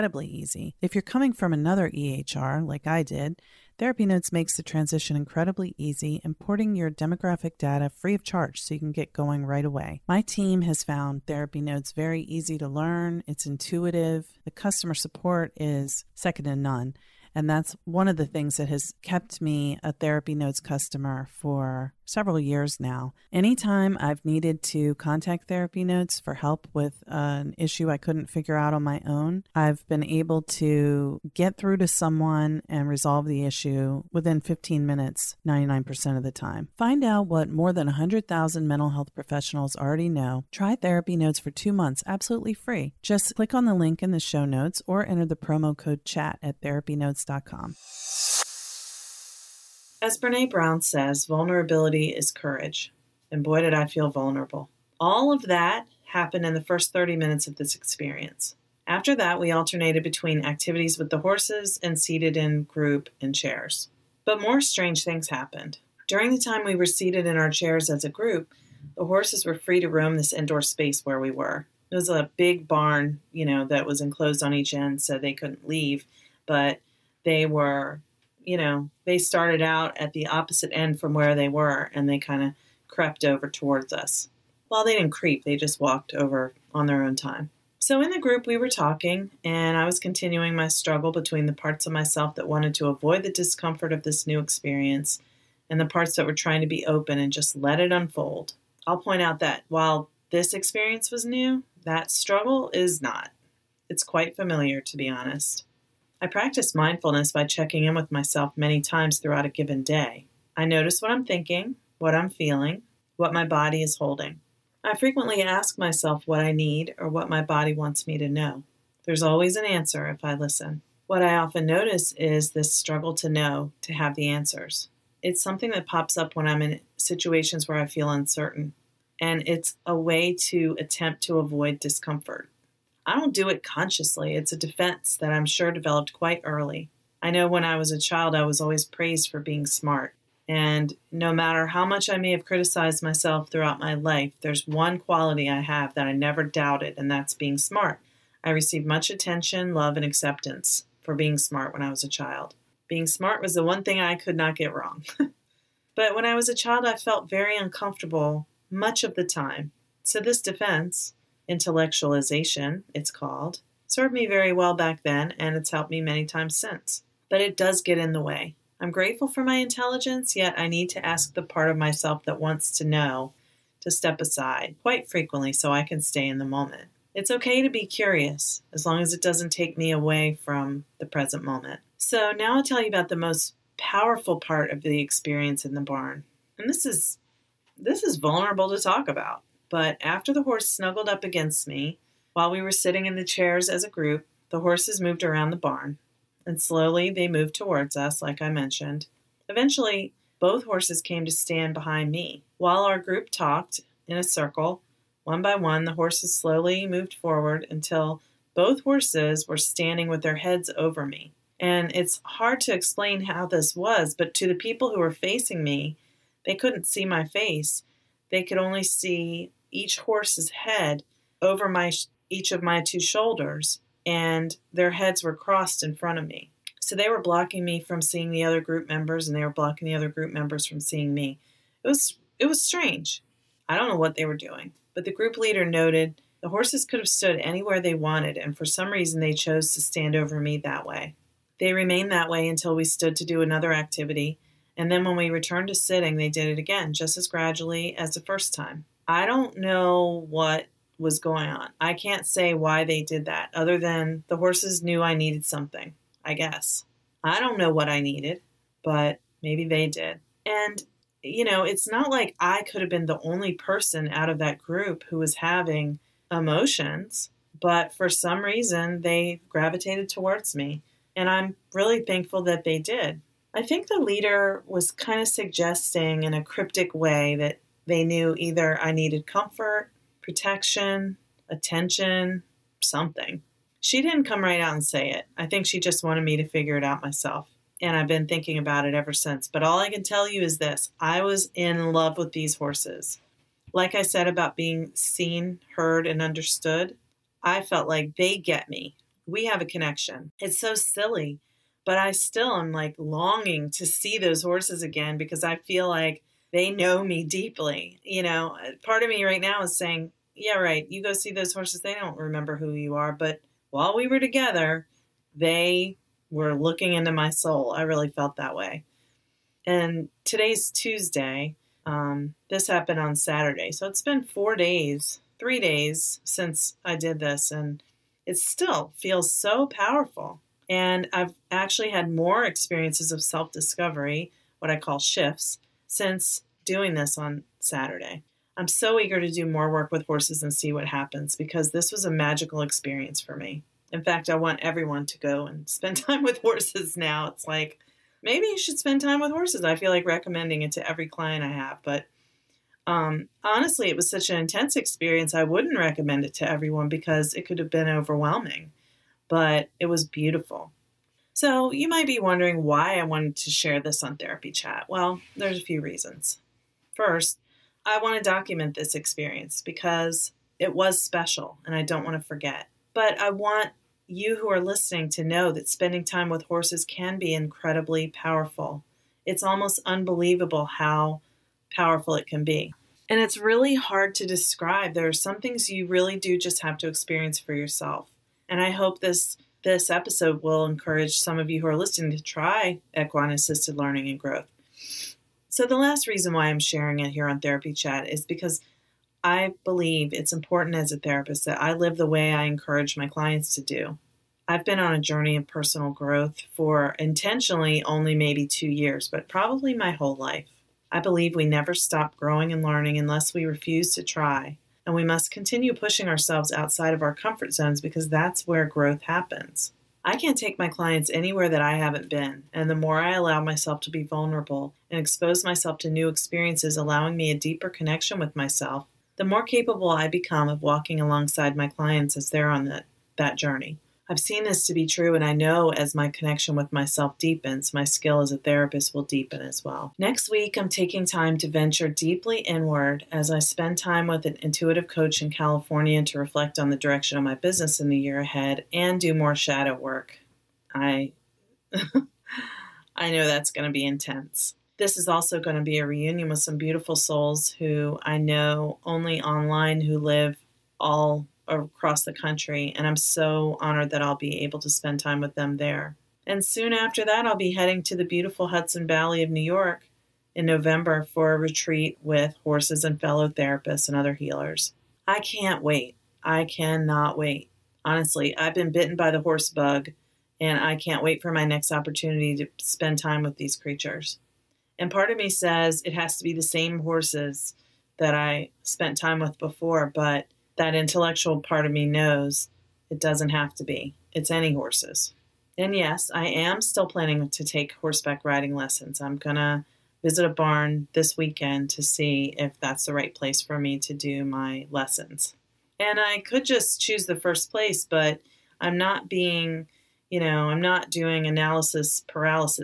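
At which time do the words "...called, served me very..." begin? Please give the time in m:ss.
2:43.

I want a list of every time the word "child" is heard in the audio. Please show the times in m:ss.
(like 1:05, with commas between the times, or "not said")
2:17, 2:32, 2:36.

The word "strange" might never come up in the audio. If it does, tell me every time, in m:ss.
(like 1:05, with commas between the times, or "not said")
1:04, 3:52.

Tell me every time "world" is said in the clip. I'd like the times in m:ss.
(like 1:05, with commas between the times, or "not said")
not said.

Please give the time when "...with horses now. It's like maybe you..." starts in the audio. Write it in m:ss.
5:46.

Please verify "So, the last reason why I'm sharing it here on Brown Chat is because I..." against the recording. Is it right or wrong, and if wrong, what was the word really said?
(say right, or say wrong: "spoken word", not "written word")
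wrong: "Therapy", not "Brown".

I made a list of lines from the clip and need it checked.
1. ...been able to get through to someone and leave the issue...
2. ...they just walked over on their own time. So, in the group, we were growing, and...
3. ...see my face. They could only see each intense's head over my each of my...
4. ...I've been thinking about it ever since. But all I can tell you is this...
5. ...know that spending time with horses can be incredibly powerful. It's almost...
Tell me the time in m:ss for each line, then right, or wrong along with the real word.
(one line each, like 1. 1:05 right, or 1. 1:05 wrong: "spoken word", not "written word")
1. 0:29 wrong: "resolve", not "leave"
2. 1:25 wrong: "talking", not "growing"
3. 3:36 wrong: "horse", not "intense"
4. 4:47 right
5. 6:15 right.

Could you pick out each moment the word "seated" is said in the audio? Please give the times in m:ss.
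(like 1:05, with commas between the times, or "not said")
1:01, 1:06.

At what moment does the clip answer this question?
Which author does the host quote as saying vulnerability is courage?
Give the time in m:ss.
0:50.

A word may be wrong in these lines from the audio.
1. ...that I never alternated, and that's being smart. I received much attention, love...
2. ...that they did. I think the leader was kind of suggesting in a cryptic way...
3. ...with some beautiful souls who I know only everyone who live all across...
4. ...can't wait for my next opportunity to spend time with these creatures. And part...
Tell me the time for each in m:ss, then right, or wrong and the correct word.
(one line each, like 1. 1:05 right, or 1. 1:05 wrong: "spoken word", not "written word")
1. 2:25 wrong: "doubted", not "alternated"
2. 4:32 right
3. 7:36 wrong: "online", not "everyone"
4. 8:00 right.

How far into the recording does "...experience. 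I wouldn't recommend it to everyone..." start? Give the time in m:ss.
5:54.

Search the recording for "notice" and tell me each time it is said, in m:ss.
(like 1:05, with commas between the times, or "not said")
1:50, 2:01.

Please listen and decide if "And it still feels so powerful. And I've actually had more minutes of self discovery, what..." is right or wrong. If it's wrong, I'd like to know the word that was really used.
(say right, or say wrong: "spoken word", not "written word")
wrong: "experiences", not "minutes".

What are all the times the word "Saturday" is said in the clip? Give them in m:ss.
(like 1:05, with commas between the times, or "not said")
5:23, 5:37.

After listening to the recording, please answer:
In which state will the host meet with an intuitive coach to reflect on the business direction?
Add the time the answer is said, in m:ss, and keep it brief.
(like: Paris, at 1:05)
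California, at 7:25.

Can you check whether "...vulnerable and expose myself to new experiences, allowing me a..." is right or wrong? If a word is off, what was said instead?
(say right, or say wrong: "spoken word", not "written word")
right.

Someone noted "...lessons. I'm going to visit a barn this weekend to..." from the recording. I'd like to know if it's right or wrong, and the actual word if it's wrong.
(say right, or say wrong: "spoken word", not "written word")
right.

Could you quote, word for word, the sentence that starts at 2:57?
It's okay to be curious as long as it doesn't take me away from the present moment.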